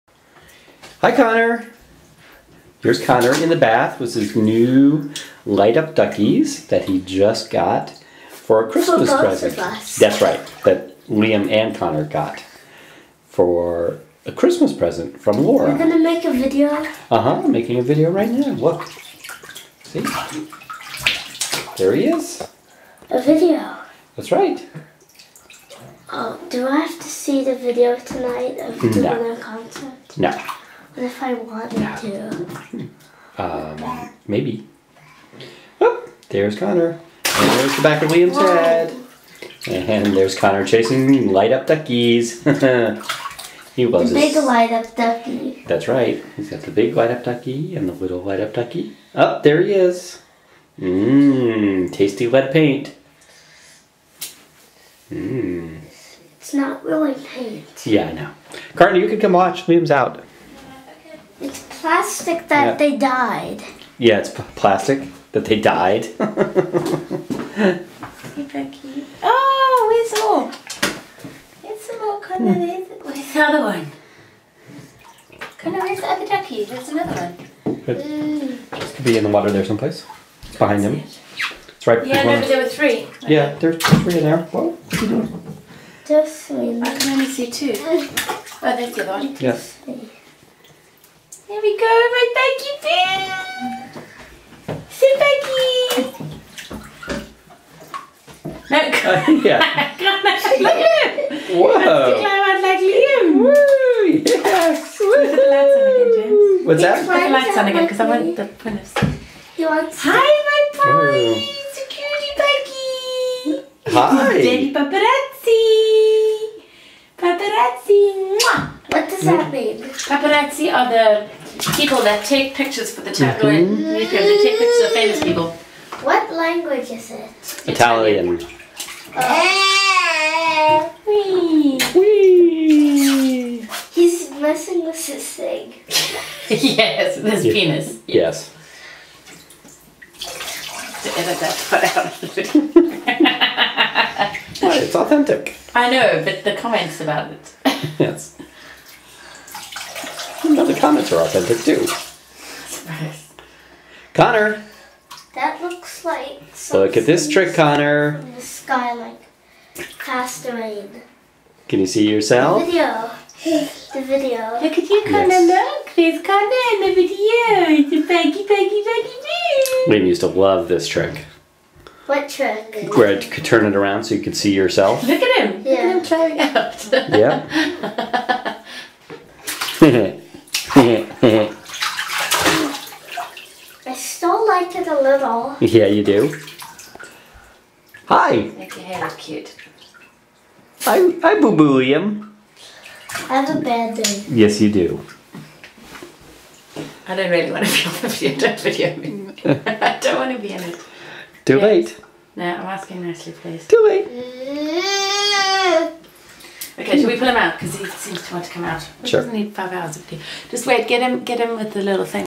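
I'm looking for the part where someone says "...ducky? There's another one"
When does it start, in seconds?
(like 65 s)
76 s.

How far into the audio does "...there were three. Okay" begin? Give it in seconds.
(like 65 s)
82 s.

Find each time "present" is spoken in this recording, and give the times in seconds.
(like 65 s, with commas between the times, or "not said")
9 s, 14 s.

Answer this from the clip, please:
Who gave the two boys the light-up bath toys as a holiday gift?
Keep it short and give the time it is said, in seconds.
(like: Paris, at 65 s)
Laura, at 15 s.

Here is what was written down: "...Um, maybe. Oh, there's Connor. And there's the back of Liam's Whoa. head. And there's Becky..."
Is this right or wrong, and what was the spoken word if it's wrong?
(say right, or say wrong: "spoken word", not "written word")
wrong: "Connor", not "Becky".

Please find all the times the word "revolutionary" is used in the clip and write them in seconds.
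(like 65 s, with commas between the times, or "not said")
not said.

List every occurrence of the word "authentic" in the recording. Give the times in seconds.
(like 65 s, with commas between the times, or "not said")
144 s, 151 s.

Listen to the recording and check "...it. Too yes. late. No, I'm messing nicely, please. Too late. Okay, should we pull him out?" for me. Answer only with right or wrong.
wrong.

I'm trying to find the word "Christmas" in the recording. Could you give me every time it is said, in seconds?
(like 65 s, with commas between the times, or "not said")
8 s, 14 s.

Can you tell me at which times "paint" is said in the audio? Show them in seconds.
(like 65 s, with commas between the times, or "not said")
52 s, 57 s.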